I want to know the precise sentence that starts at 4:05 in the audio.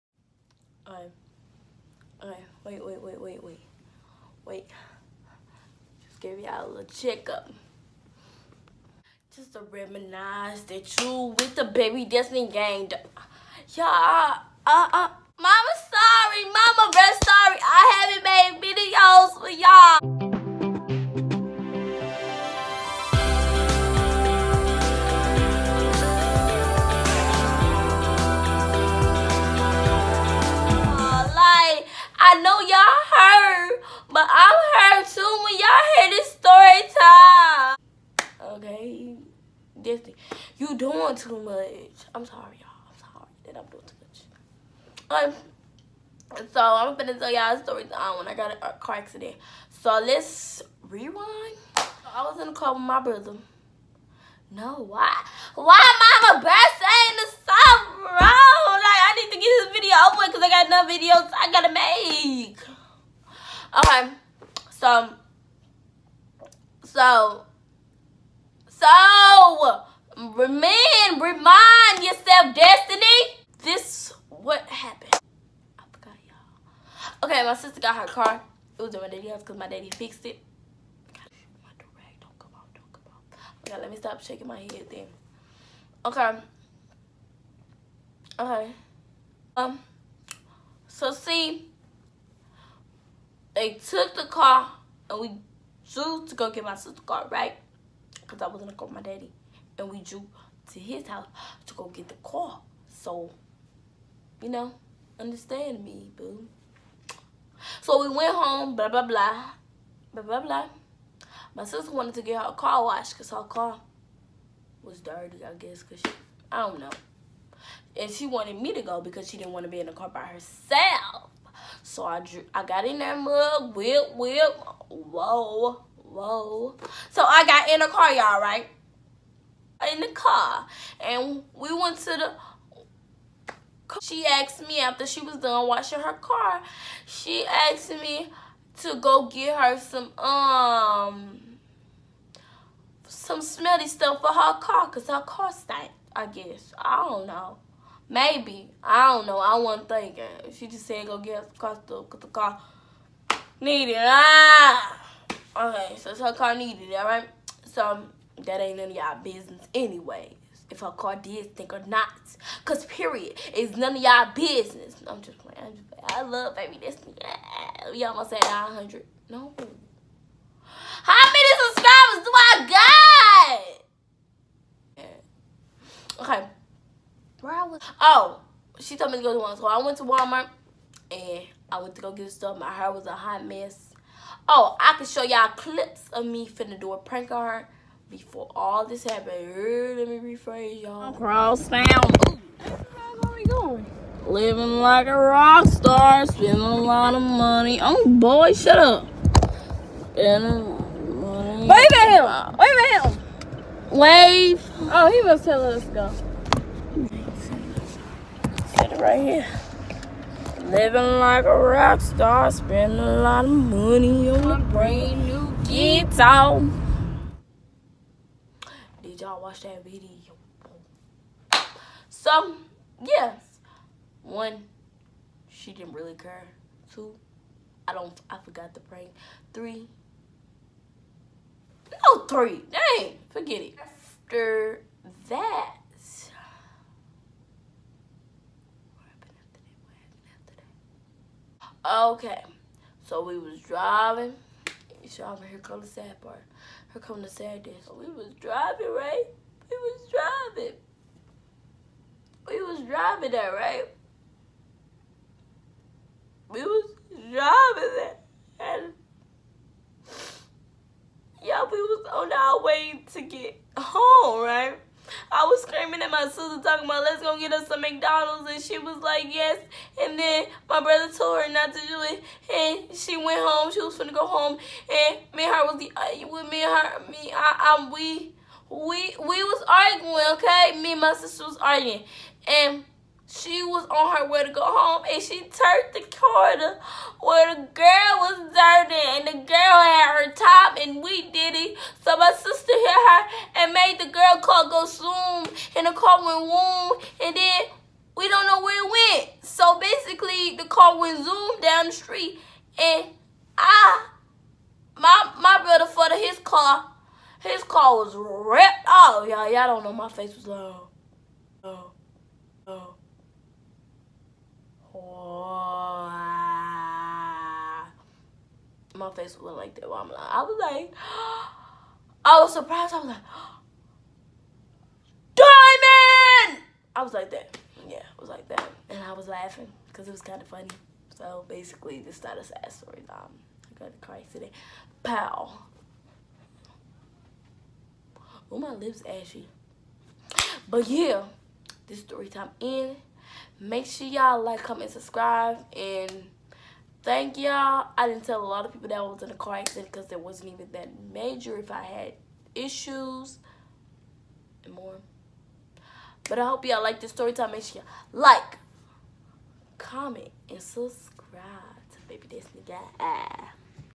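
Y'all, here go the sad part her coming to Saturday.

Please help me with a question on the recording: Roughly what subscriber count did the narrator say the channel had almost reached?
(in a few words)
900.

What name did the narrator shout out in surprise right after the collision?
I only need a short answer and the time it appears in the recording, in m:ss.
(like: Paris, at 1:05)
Diamond, at 5:25.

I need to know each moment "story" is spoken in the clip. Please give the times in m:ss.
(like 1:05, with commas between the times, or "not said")
0:47, 5:32, 5:42, 5:57.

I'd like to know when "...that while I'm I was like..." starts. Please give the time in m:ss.
5:19.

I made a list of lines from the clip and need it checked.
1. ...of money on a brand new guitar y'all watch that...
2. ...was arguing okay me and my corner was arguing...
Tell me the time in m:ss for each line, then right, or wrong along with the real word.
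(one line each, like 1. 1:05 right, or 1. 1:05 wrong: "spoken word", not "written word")
1. 3:33 right
2. 4:39 wrong: "sister", not "corner".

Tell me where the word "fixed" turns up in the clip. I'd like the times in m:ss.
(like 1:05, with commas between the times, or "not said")
1:19.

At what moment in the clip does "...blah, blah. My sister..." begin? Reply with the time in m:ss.
1:50.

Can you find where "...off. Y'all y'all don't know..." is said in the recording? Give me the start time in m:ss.
5:08.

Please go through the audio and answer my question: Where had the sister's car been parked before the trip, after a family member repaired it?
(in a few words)
Daddy's house.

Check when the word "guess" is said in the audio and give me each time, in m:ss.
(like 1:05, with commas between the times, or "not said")
1:55, 2:26.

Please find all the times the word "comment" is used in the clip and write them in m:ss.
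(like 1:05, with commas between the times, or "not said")
5:44, 5:59.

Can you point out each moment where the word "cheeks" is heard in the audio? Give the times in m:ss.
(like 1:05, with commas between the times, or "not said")
not said.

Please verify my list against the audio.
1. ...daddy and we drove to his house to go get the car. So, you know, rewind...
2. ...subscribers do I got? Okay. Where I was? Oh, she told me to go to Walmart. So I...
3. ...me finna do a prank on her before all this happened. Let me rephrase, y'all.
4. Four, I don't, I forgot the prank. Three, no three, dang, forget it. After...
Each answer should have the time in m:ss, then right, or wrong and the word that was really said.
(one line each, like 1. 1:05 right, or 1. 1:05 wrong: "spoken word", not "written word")
1. 1:39 wrong: "understand", not "rewind"
2. 2:51 right
3. 3:06 right
4. 3:46 wrong: "Two", not "Four".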